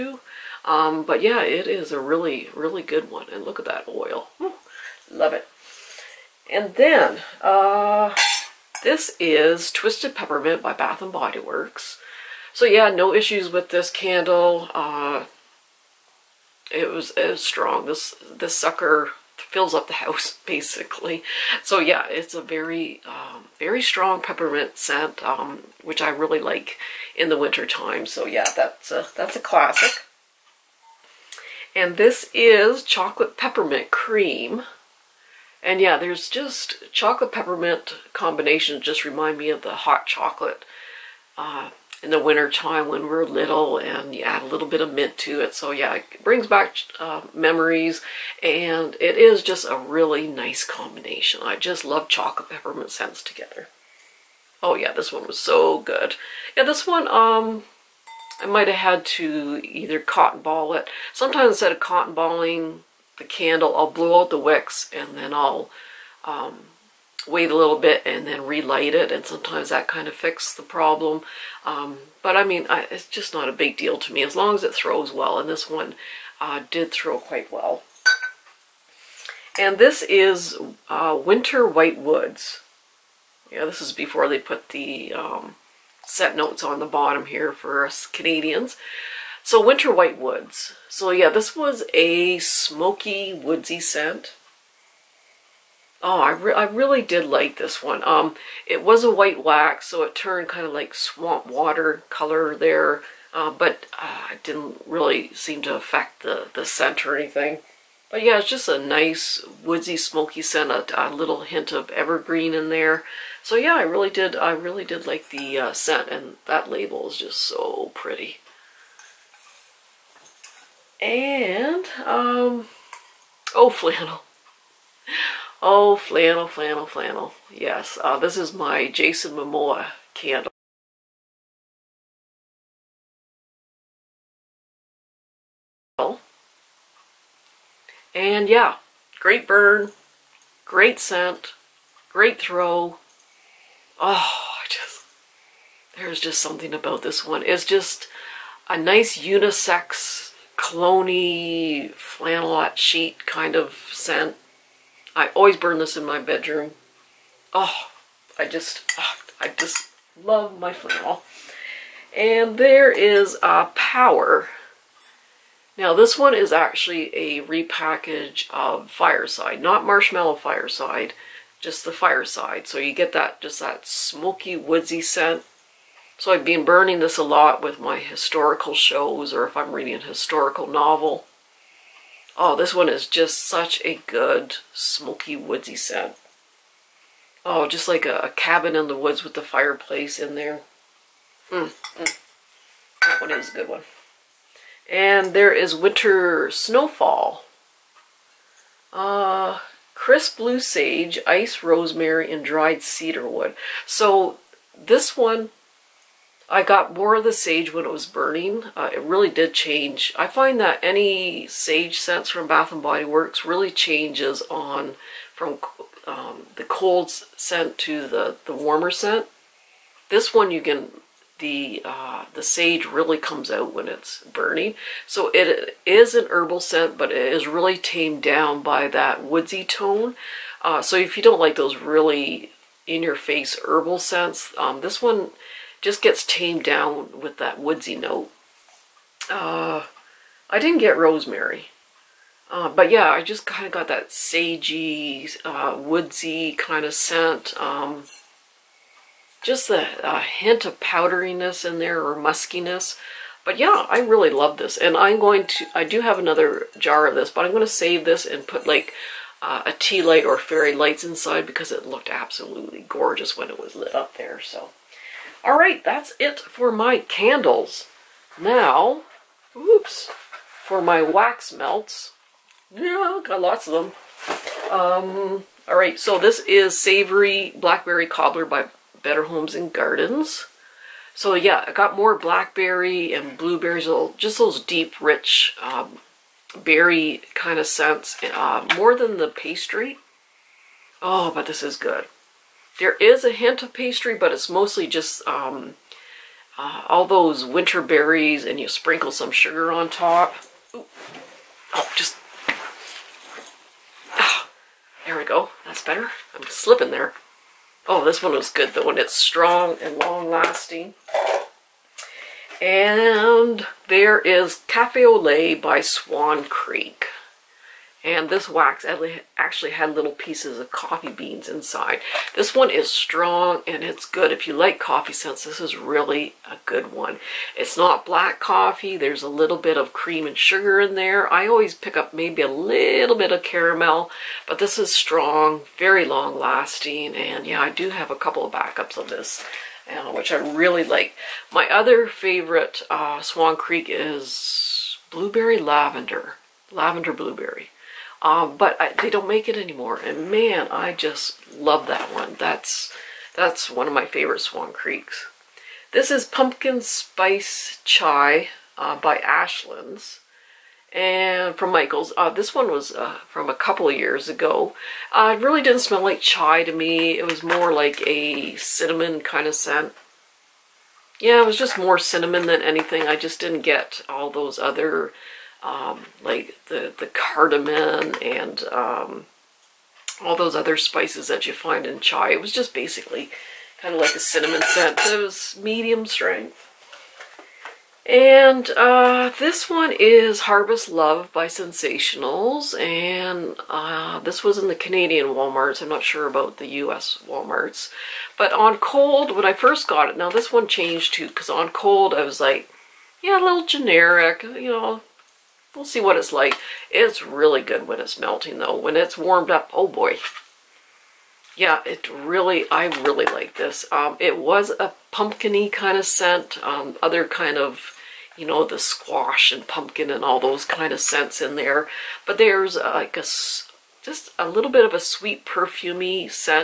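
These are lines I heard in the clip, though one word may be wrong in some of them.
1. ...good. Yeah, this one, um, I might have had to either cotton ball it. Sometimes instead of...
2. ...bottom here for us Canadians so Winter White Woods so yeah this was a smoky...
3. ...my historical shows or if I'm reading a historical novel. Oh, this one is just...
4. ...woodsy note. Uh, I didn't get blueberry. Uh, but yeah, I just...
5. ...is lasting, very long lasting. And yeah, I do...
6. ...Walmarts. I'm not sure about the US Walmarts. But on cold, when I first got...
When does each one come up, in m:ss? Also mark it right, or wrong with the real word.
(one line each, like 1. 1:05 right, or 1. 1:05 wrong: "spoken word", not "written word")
1. 0:55 right
2. 1:26 right
3. 2:57 right
4. 3:57 wrong: "rosemary", not "blueberry"
5. 5:34 wrong: "strong", not "lasting"
6. 6:35 right.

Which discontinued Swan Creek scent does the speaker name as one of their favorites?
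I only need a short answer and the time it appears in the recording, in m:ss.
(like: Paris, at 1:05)
blueberry lavender, at 5:45.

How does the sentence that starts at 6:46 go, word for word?
It's really good when it's melting, though.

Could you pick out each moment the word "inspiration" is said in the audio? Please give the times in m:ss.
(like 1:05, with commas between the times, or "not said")
not said.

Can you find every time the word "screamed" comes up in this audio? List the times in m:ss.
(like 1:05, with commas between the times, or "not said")
not said.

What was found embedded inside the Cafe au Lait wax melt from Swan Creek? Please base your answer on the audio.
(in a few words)
coffee beans.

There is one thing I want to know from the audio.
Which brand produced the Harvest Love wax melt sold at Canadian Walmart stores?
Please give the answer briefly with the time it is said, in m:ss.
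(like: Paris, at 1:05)
Scentsationals, at 6:31.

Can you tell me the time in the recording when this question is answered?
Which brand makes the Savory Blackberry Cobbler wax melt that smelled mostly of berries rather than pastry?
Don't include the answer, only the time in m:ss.
4:39.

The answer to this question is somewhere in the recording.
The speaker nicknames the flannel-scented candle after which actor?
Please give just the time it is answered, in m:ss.
2:08.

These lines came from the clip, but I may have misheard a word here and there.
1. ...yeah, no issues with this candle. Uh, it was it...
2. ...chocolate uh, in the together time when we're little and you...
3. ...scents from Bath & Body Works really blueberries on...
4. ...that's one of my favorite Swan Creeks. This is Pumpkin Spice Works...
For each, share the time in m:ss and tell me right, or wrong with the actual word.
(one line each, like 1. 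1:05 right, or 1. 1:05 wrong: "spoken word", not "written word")
1. 0:12 right
2. 0:40 wrong: "winter", not "together"
3. 3:32 wrong: "changes", not "blueberries"
4. 5:53 wrong: "Chai", not "Works".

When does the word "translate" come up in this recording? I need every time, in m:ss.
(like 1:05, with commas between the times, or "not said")
not said.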